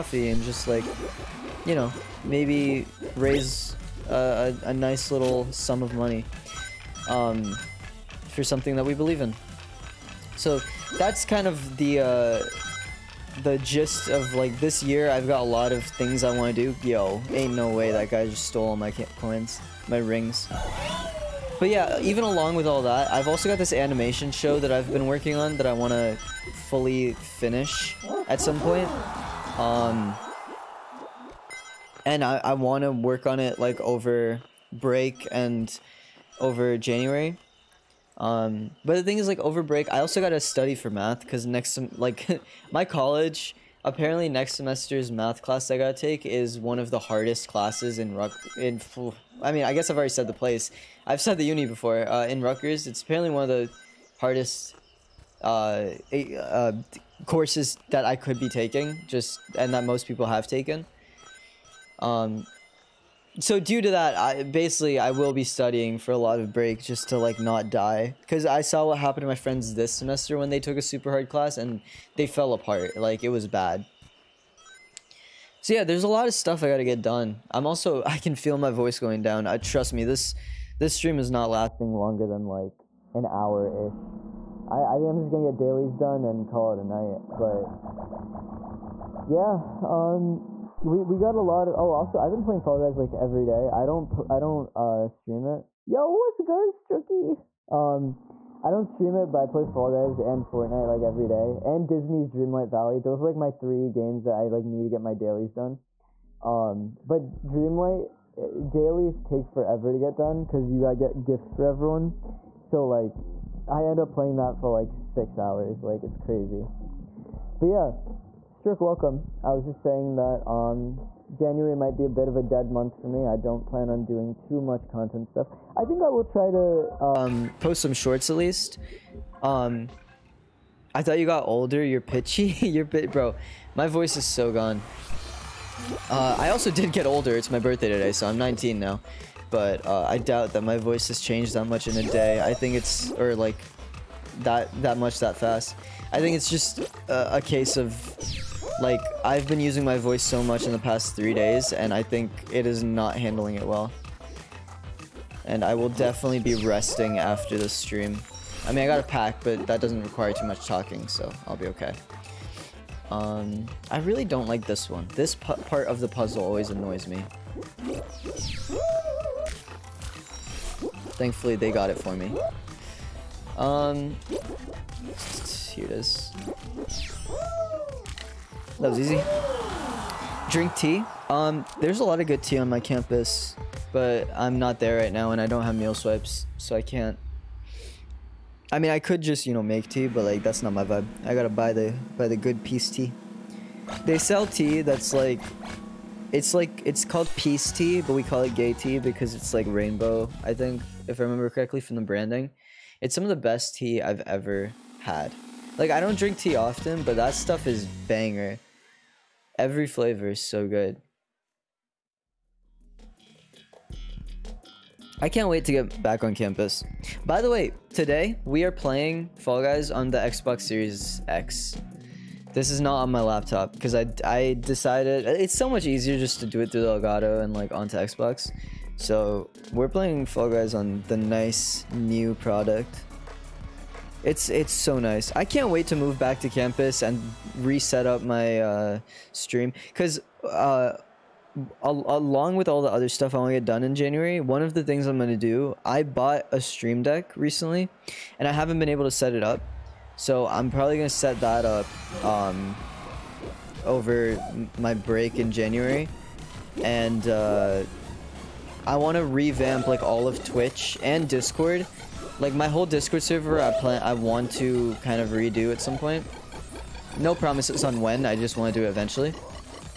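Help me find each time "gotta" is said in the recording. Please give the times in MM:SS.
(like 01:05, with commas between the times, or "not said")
00:45, 01:16, 01:50, 03:11.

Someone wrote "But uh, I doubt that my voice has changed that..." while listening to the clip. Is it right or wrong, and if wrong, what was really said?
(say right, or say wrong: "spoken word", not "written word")
right.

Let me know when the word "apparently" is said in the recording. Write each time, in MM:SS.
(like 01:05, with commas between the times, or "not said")
00:43, 00:53.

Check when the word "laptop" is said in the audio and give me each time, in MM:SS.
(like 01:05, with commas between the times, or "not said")
03:43.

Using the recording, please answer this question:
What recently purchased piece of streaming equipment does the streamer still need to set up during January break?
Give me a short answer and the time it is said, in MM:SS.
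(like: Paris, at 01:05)
Stream Deck, at 04:06.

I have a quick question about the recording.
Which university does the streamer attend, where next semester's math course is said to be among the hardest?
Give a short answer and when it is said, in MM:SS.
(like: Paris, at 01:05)
Rutgers, at 00:52.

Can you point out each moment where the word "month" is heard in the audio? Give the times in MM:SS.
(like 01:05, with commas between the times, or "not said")
02:02.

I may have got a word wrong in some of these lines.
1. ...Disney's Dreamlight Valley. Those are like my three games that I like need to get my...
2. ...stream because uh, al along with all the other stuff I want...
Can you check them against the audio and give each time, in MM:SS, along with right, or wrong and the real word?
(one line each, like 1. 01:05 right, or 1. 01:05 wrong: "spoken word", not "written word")
1. 01:41 right
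2. 03:59 right.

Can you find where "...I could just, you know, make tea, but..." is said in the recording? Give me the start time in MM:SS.
03:08.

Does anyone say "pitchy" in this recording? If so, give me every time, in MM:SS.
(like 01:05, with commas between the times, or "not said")
02:12.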